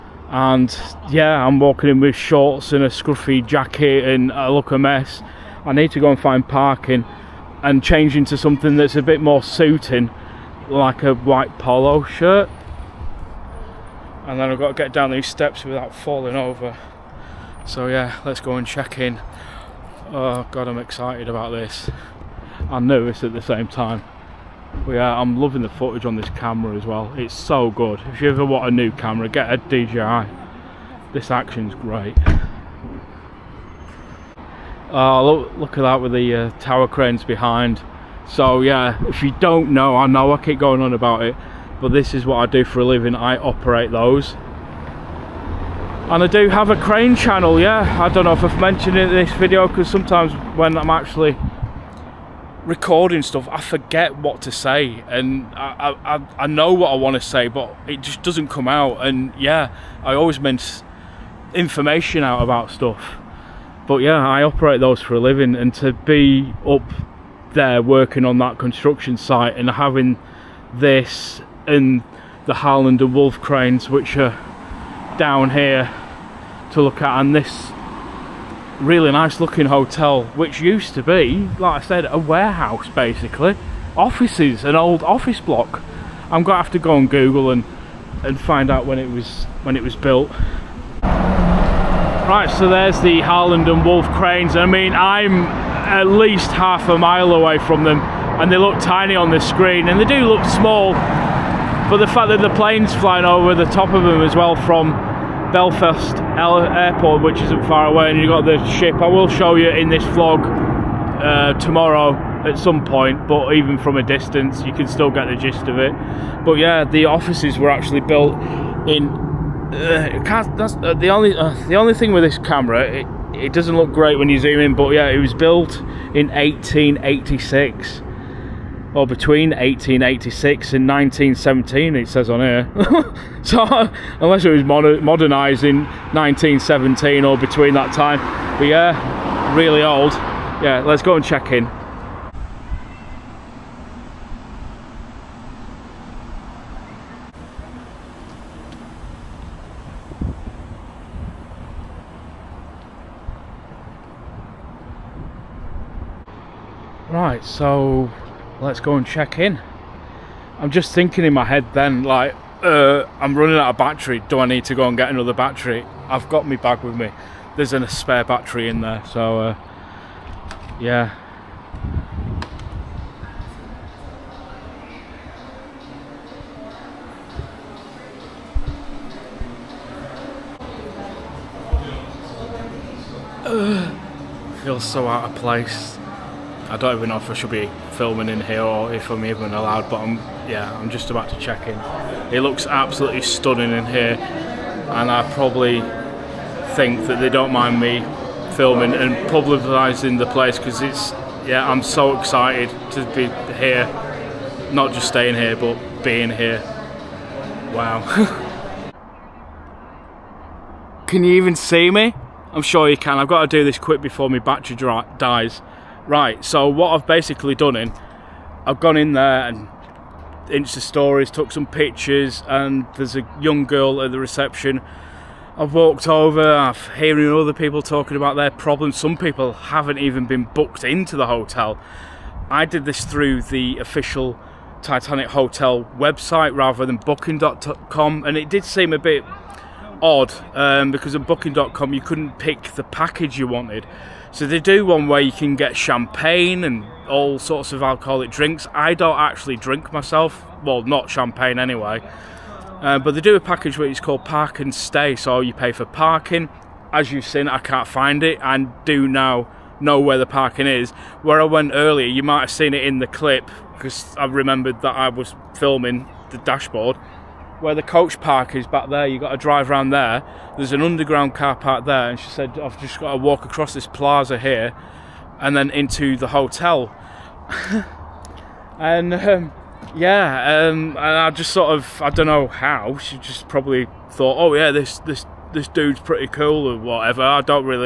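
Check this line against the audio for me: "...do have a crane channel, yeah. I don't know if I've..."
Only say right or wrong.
right.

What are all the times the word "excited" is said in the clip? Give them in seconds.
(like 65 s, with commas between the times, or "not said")
20 s, 202 s.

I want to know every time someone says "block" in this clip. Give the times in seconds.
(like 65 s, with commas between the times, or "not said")
85 s.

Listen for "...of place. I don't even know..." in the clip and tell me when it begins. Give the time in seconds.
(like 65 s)
185 s.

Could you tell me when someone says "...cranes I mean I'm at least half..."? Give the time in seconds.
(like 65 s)
94 s.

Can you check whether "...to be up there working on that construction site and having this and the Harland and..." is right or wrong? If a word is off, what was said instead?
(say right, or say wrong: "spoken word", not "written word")
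right.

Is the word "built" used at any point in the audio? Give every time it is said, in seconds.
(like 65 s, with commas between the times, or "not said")
89 s, 118 s, 125 s.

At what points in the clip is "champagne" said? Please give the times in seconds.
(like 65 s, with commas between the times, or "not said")
245 s, 251 s.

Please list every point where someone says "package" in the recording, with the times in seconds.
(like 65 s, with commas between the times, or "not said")
242 s, 253 s.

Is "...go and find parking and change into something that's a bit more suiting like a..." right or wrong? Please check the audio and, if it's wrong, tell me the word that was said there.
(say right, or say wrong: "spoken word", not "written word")
right.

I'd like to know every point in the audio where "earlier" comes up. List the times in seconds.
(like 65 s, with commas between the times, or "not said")
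261 s.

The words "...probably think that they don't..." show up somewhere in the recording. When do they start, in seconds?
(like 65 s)
195 s.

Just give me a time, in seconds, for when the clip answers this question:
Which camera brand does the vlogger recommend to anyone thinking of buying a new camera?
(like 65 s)
29 s.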